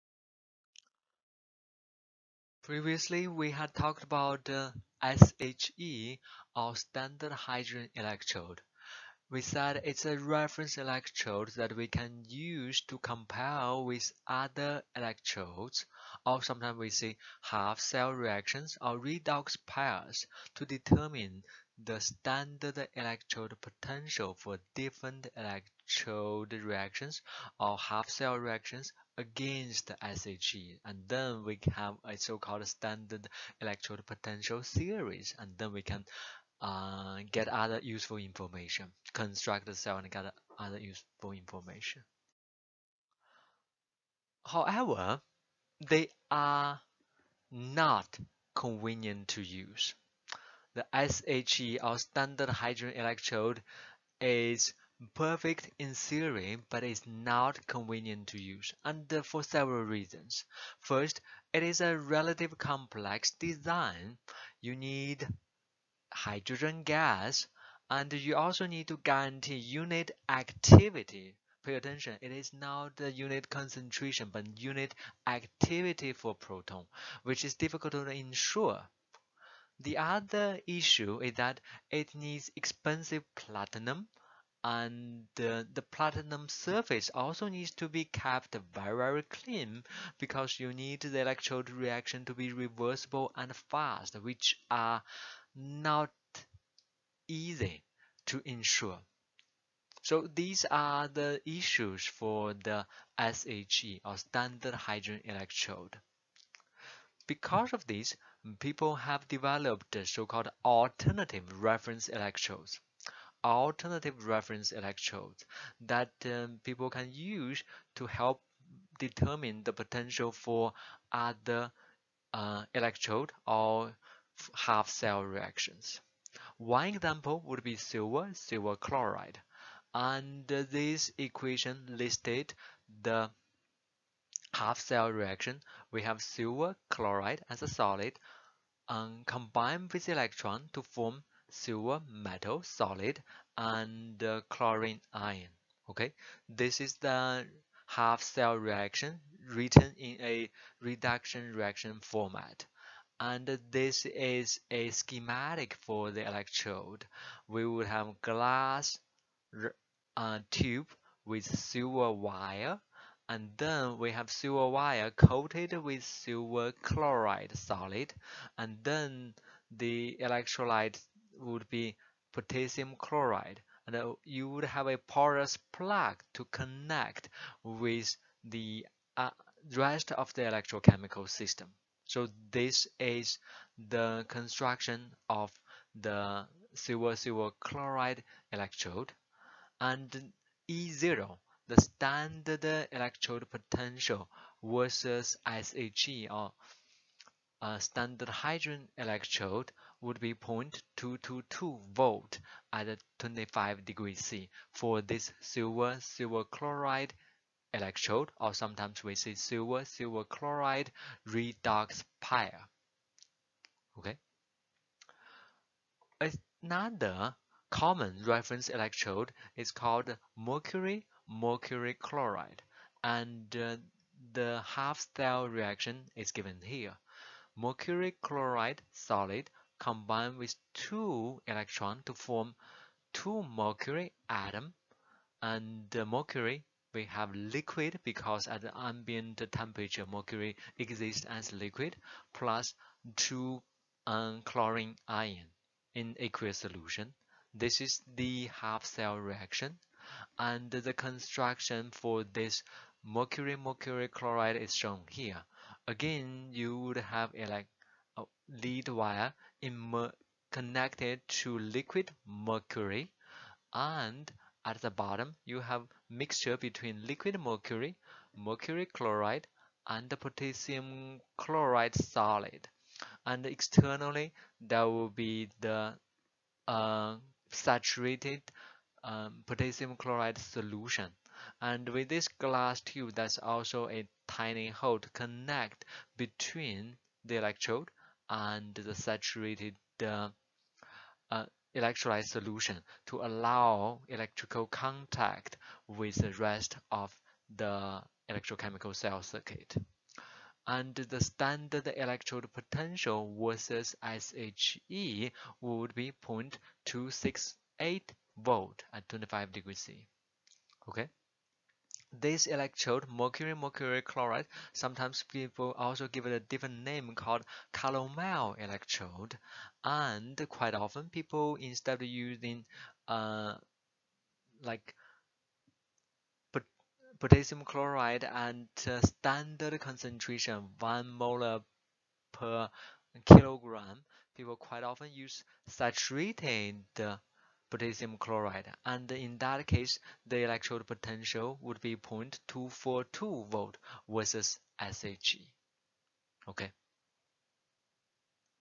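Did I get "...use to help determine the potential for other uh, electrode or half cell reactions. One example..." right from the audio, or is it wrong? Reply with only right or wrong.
right.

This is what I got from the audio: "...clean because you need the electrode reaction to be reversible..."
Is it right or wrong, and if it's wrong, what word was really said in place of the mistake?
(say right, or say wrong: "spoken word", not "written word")
right.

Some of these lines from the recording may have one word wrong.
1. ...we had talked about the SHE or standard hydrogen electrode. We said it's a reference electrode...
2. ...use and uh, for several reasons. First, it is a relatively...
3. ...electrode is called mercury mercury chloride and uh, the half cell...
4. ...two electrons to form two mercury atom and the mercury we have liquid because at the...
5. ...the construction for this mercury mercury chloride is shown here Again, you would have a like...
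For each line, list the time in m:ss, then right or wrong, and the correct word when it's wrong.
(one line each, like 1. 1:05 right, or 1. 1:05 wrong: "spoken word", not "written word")
1. 0:03 right
2. 0:58 right
3. 3:38 right
4. 3:50 right
5. 4:10 right.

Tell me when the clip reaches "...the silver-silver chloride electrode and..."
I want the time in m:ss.
3:05.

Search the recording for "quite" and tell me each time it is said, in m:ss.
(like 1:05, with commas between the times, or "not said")
5:20, 5:34.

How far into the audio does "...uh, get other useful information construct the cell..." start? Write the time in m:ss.
0:36.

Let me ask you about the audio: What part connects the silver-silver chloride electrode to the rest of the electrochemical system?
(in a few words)
porous plug.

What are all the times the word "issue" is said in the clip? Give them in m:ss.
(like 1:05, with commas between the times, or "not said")
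1:20, 1:41.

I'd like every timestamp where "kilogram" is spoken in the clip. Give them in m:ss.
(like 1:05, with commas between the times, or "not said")
5:33.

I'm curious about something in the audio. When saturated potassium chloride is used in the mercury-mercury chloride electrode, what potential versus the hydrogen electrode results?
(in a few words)
0.242 volt.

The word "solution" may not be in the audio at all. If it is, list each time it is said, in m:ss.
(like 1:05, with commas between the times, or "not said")
4:06, 4:40, 4:52.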